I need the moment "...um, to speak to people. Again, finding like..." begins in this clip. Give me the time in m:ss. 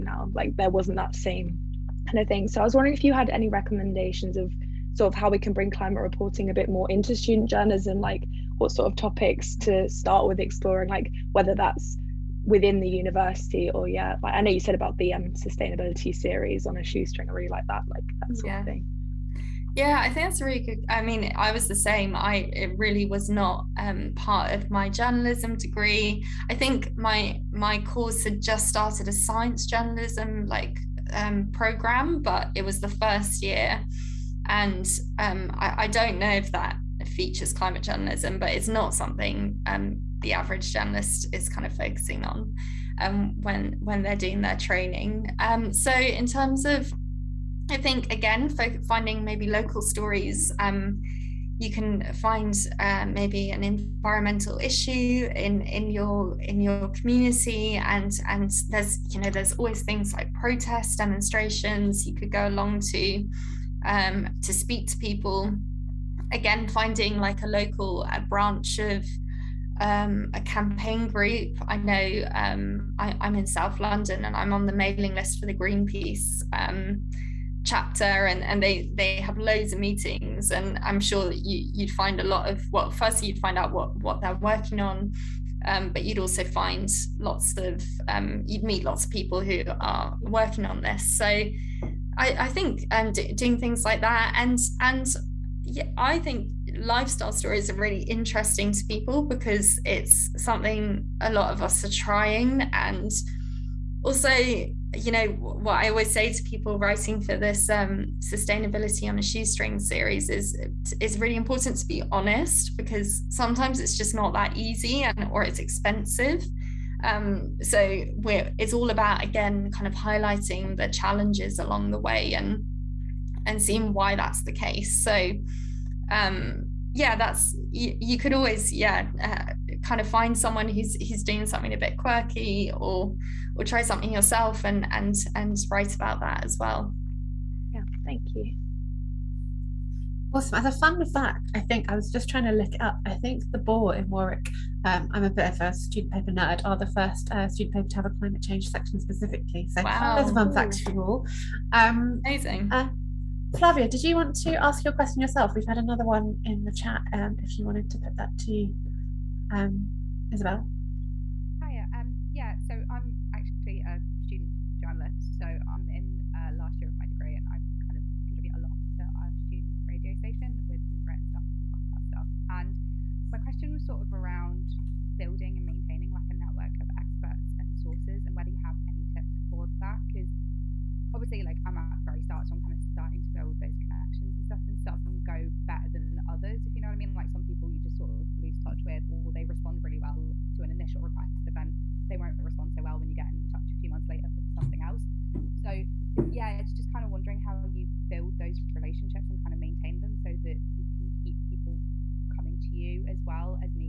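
1:03.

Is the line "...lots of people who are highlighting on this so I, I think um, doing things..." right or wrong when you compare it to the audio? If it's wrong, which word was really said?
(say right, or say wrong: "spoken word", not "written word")
wrong: "working", not "highlighting".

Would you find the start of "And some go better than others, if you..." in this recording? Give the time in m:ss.
3:04.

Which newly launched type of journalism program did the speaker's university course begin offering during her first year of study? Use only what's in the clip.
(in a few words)
science journalism.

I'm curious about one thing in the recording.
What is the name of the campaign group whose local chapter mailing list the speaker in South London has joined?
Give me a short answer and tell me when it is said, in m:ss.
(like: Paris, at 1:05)
Greenpeace, at 1:15.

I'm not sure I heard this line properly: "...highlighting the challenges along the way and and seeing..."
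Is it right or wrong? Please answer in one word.
right.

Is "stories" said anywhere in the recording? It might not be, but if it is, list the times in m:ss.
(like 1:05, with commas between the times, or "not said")
0:49, 1:37.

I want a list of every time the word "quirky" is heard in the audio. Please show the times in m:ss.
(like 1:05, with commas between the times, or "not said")
2:11.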